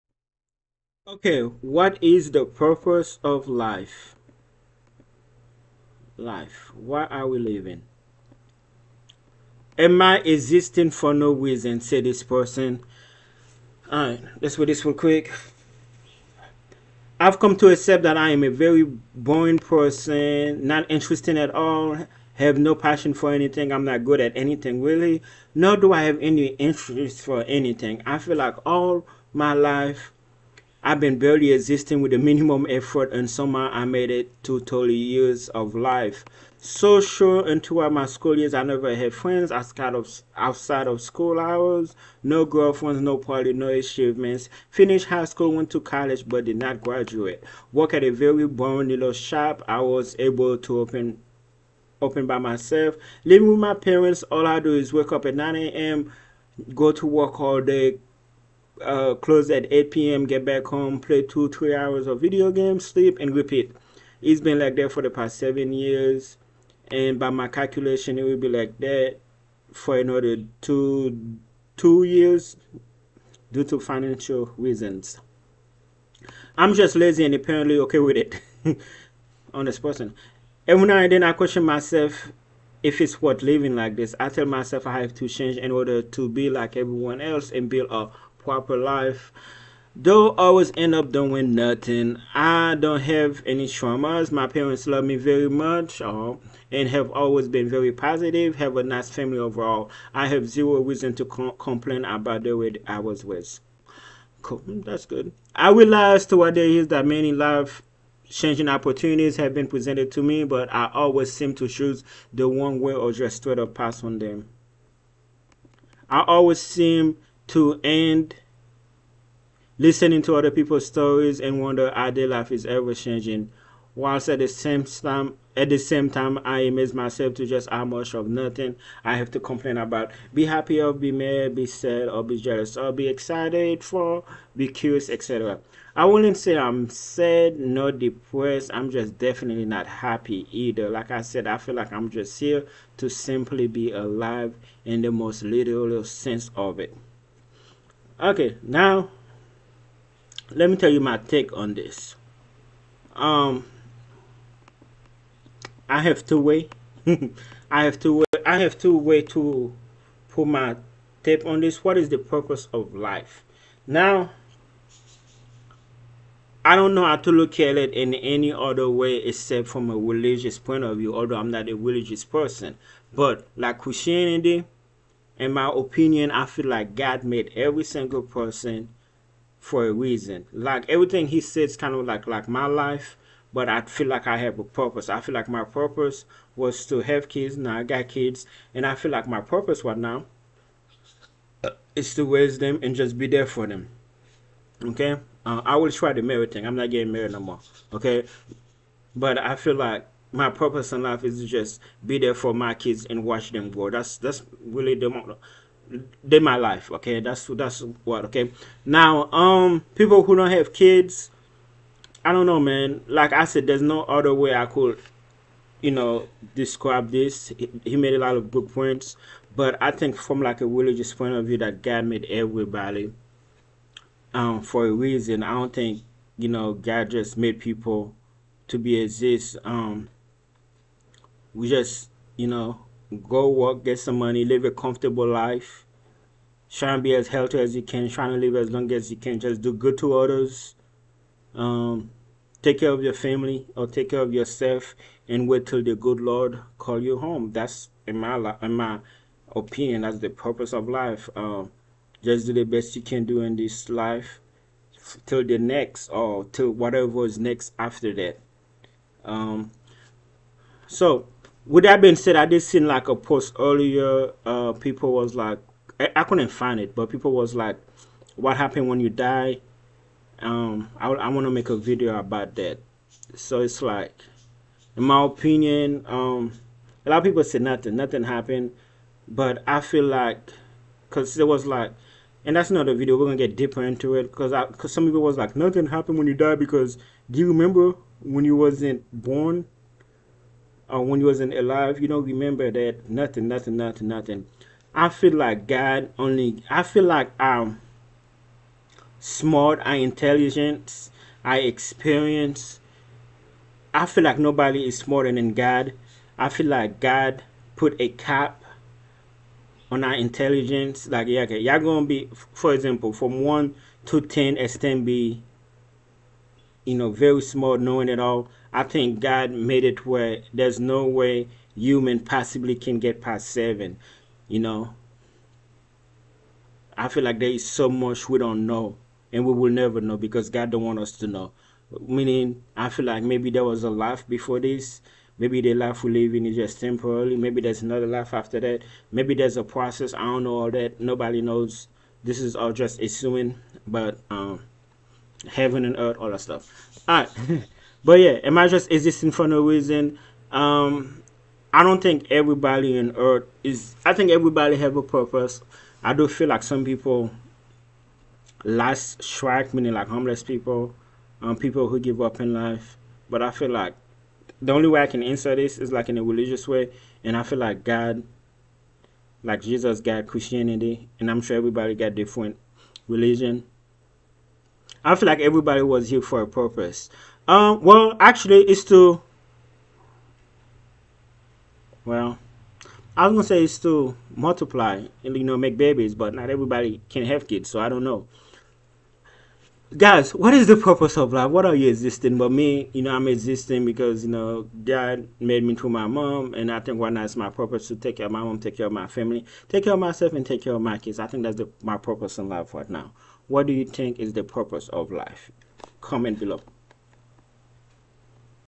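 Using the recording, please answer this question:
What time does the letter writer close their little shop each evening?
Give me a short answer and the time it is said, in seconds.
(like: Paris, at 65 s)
8 p.m., at 59 s.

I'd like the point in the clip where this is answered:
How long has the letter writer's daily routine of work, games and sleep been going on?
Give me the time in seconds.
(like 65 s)
65 s.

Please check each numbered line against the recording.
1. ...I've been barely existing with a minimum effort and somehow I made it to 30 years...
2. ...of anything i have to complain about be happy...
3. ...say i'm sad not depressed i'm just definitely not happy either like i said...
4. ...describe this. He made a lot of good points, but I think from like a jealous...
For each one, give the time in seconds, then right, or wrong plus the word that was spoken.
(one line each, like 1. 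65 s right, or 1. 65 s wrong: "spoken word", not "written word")
1. 30 s right
2. 128 s wrong: "nothing", not "anything"
3. 136 s right
4. 216 s wrong: "religious", not "jealous".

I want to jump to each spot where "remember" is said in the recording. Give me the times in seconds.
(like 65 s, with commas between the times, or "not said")
287 s, 292 s.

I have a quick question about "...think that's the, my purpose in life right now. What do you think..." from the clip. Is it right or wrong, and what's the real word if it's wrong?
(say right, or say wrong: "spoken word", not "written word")
right.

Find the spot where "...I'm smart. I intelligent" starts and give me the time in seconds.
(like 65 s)
297 s.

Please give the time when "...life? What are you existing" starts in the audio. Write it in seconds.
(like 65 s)
391 s.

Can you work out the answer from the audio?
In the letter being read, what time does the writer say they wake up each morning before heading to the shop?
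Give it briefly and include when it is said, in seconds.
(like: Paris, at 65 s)
9 a.m., at 55 s.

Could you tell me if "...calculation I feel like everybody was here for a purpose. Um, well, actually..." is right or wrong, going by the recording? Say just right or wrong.
wrong.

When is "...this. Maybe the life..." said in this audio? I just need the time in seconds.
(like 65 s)
334 s.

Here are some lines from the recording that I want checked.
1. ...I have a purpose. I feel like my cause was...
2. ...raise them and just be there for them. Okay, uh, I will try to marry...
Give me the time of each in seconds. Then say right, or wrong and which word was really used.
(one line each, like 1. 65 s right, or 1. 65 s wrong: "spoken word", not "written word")
1. 184 s wrong: "purpose", not "cause"
2. 192 s right.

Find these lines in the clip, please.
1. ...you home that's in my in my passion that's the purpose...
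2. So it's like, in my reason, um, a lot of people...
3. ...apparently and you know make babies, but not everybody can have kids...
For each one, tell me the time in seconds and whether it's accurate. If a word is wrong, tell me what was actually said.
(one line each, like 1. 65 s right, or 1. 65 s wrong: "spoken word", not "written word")
1. 247 s wrong: "opinion", not "passion"
2. 273 s wrong: "opinion", not "reason"
3. 384 s wrong: "multiply", not "apparently".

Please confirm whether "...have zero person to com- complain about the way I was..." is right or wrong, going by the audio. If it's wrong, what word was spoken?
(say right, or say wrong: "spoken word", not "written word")
wrong: "reason", not "person".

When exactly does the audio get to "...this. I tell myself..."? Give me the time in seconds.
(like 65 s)
83 s.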